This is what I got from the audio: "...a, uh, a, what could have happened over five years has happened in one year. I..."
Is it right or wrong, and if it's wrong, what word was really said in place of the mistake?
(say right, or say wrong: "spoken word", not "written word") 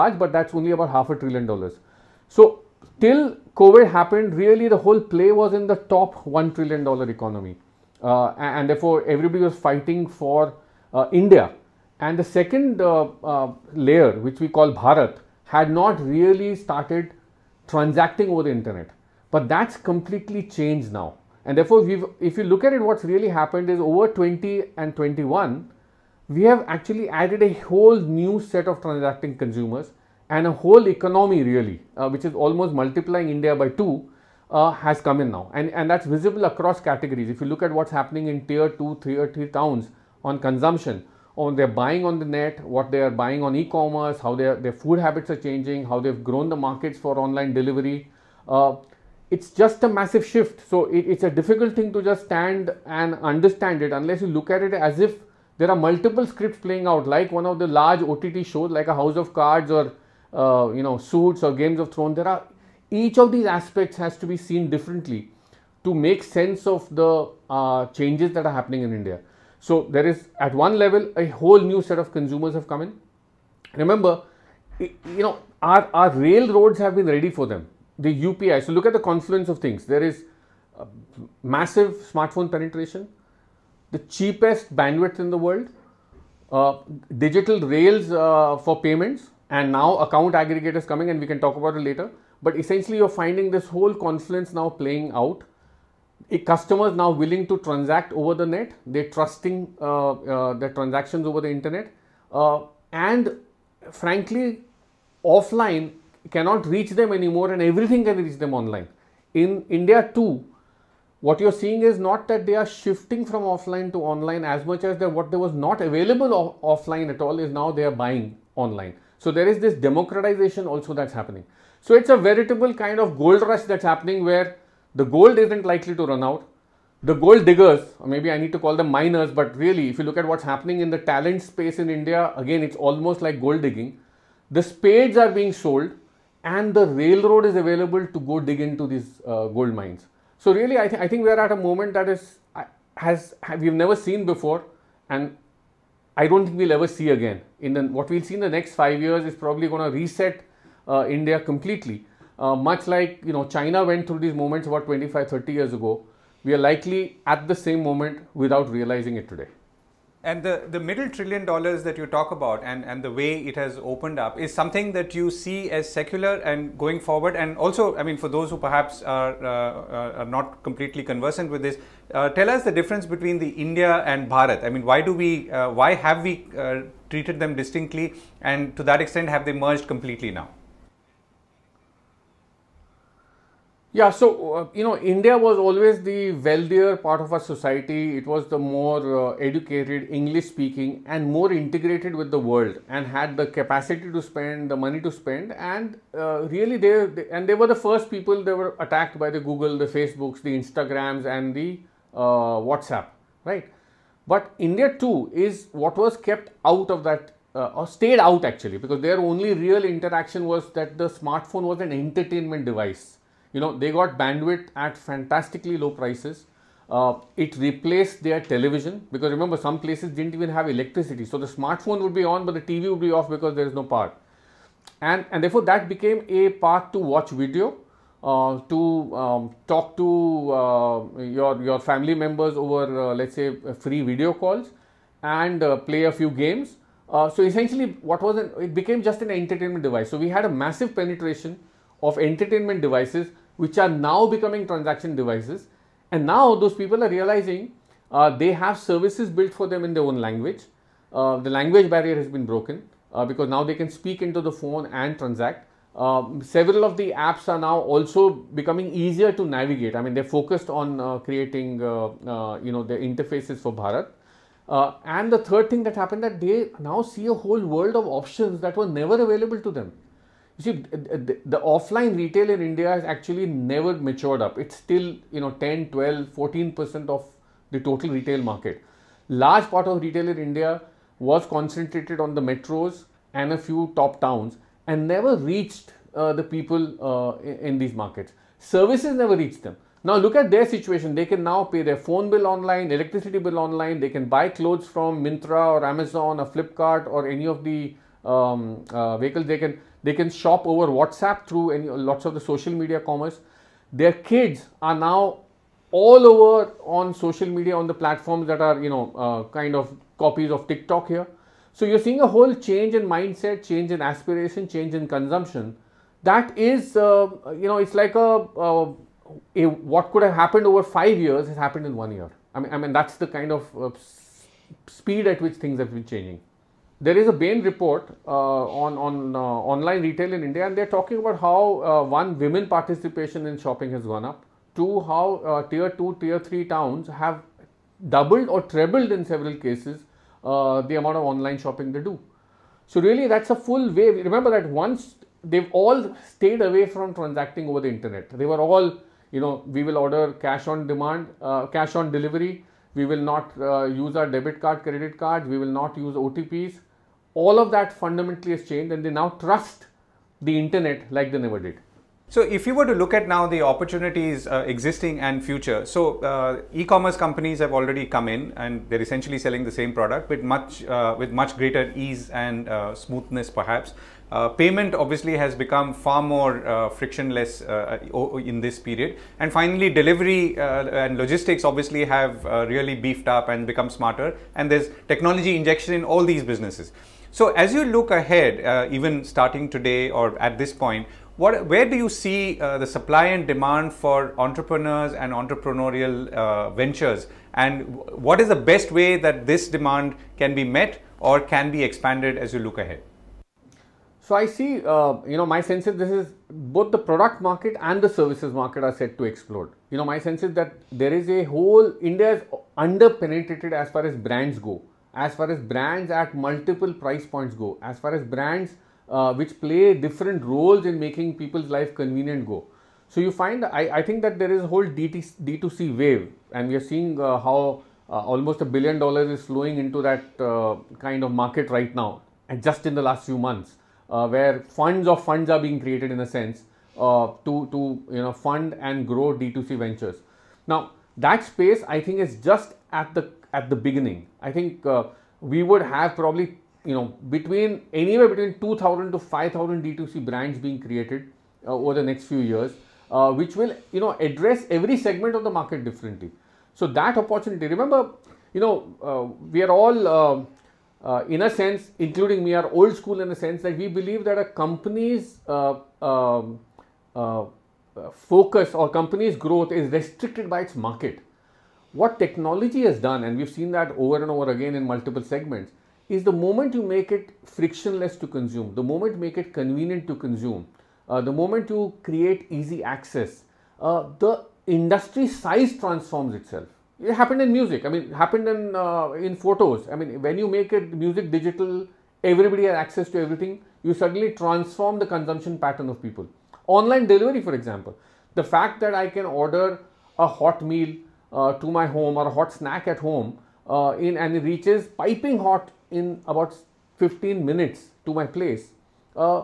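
right.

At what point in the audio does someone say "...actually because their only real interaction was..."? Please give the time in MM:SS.
03:28.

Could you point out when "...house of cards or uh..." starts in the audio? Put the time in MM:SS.
00:58.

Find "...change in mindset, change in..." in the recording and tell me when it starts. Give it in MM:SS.
05:12.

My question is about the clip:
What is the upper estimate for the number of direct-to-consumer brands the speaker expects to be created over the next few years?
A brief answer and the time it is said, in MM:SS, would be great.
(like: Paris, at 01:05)
5,000, at 07:29.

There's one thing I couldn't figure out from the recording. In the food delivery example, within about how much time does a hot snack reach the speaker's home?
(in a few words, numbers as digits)
15 minutes.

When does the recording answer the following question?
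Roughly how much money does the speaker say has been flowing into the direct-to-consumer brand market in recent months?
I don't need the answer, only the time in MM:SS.
07:08.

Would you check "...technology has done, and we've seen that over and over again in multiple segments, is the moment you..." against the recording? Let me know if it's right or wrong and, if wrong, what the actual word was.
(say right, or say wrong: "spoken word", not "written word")
right.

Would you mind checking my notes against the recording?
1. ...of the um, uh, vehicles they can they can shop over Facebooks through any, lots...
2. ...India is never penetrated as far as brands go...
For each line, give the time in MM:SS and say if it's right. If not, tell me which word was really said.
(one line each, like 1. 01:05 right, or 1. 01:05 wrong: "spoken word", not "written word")
1. 04:57 wrong: "WhatsApp", not "Facebooks"
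2. 06:52 wrong: "under", not "never".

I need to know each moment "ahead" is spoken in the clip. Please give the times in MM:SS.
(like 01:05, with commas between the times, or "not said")
06:28, 06:42.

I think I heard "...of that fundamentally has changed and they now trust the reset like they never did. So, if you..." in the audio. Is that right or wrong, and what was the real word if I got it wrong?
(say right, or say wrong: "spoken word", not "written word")
wrong: "internet", not "reset".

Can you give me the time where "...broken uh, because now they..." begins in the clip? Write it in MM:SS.
04:12.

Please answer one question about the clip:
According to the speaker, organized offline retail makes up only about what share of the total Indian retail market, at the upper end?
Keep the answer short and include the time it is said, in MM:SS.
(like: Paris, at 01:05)
14%, at 04:36.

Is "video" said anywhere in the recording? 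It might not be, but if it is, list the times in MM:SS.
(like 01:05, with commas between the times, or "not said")
03:47, 03:54.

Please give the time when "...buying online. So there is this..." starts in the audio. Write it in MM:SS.
01:57.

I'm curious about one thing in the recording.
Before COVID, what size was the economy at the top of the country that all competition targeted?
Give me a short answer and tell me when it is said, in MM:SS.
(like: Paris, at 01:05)
1 trillion dollars, at 00:06.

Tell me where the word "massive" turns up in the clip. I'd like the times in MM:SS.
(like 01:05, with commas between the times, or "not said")
00:49, 01:21, 04:00.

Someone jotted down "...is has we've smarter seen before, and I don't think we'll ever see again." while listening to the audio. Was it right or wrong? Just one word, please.
wrong.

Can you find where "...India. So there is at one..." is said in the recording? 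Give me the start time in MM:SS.
01:08.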